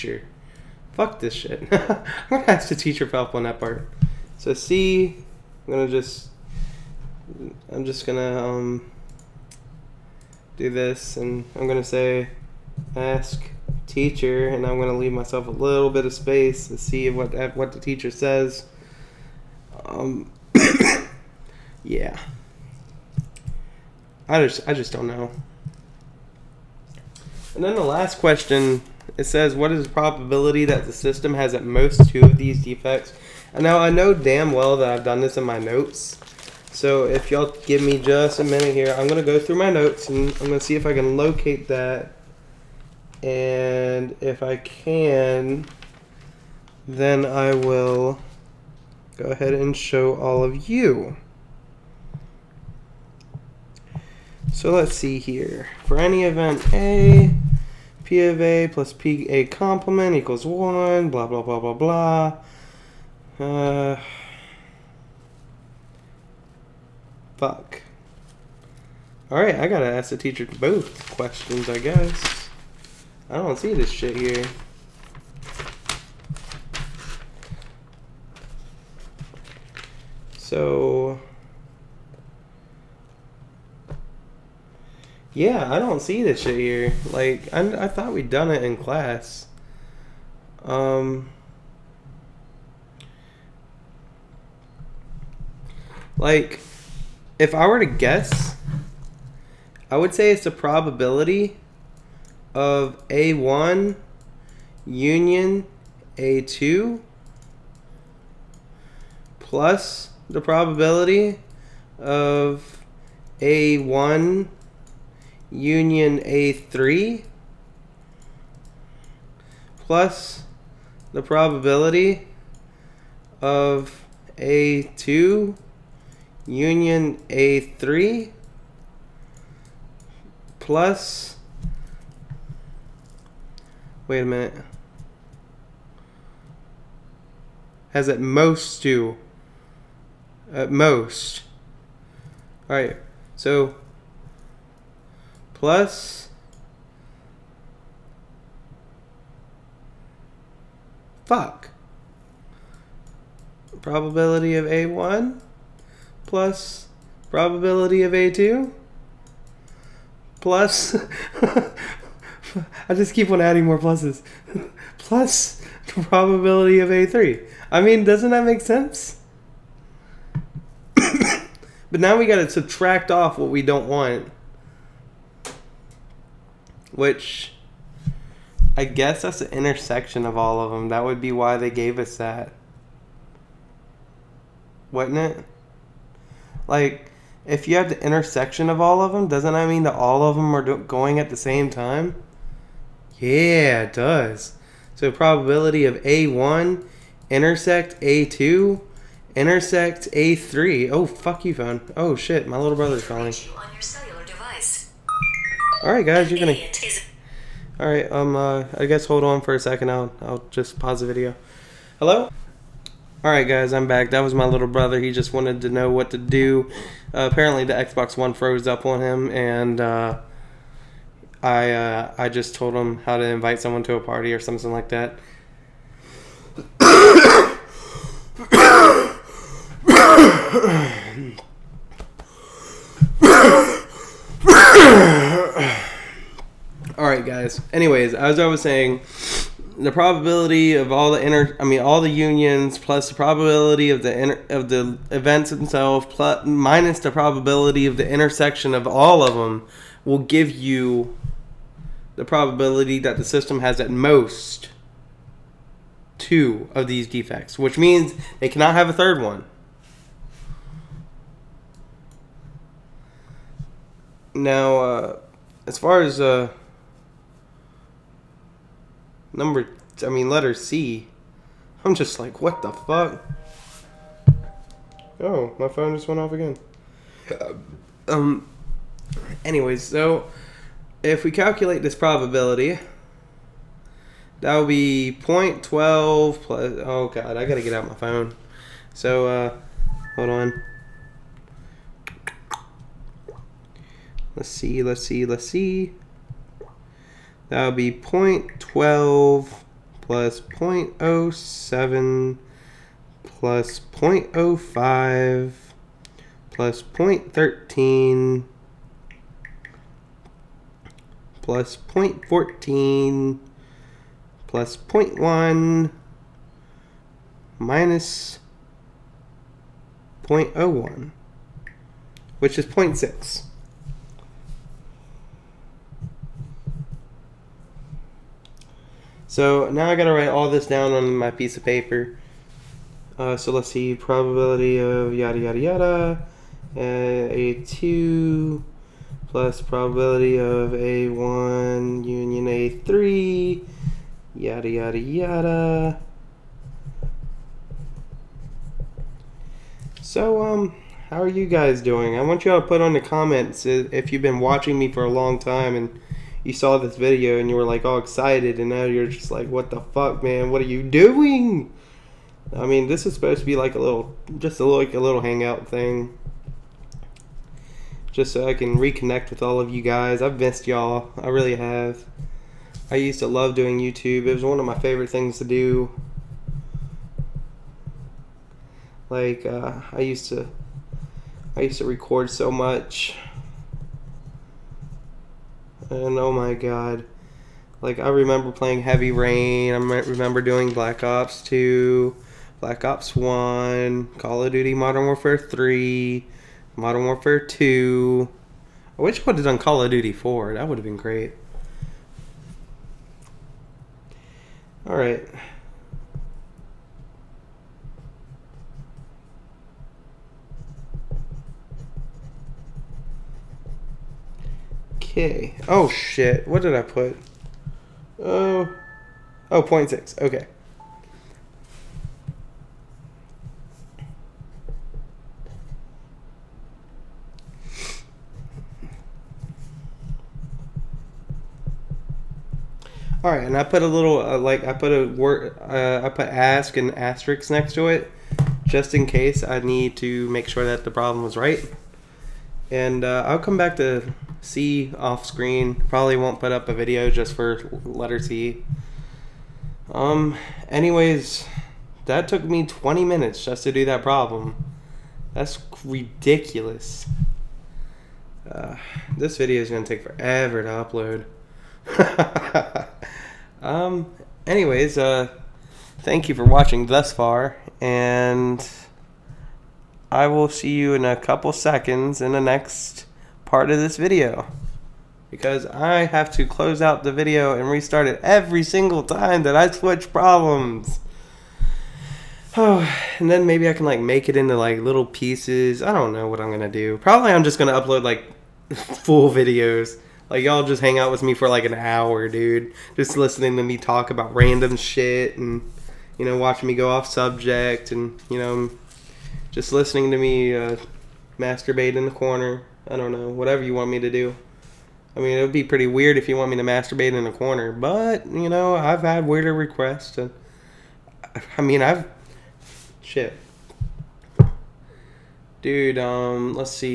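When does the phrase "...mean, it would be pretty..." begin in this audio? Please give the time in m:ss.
8:25.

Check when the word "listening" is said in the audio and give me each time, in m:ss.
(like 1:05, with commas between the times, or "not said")
8:13, 8:19.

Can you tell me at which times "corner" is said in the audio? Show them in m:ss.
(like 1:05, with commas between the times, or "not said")
8:22, 8:27.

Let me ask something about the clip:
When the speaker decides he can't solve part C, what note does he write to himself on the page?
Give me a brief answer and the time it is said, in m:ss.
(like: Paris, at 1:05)
ask teacher, at 0:12.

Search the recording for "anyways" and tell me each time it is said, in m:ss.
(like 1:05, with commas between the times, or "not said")
3:57, 4:39, 7:30, 7:44.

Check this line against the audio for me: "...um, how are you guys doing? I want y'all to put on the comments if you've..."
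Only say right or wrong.
right.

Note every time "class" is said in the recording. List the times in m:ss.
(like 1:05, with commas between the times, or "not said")
1:28.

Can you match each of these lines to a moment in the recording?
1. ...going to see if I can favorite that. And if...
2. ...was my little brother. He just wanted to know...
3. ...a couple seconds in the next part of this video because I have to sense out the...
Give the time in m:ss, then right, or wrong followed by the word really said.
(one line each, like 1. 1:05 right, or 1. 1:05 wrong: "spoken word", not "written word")
1. 0:40 wrong: "locate", not "favorite"
2. 3:34 right
3. 7:51 wrong: "close", not "sense".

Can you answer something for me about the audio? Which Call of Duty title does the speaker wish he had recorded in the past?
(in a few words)
Call of Duty 4.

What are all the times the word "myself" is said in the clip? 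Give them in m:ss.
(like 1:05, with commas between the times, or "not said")
0:15.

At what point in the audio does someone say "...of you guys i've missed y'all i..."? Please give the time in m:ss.
6:09.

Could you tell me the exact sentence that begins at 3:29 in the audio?
I'll I'll just pause the video.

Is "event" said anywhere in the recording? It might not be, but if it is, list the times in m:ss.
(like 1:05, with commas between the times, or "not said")
0:56, 4:05.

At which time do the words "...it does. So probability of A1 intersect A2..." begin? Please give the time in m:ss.
3:13.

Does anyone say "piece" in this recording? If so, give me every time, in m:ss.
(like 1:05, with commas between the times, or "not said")
5:31, 8:05.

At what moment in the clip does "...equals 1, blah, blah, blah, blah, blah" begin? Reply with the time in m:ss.
1:00.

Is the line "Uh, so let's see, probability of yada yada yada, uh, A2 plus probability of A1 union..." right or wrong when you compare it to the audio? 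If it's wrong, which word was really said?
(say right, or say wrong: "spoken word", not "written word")
right.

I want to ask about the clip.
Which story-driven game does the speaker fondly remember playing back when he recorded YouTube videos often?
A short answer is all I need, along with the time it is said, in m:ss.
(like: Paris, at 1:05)
Heavy Rain, at 6:28.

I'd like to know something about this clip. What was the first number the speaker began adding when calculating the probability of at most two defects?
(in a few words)
0.12.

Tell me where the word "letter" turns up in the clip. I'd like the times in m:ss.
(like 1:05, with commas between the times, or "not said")
4:30, 7:27.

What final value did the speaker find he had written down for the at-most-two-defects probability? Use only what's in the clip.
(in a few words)
0.6.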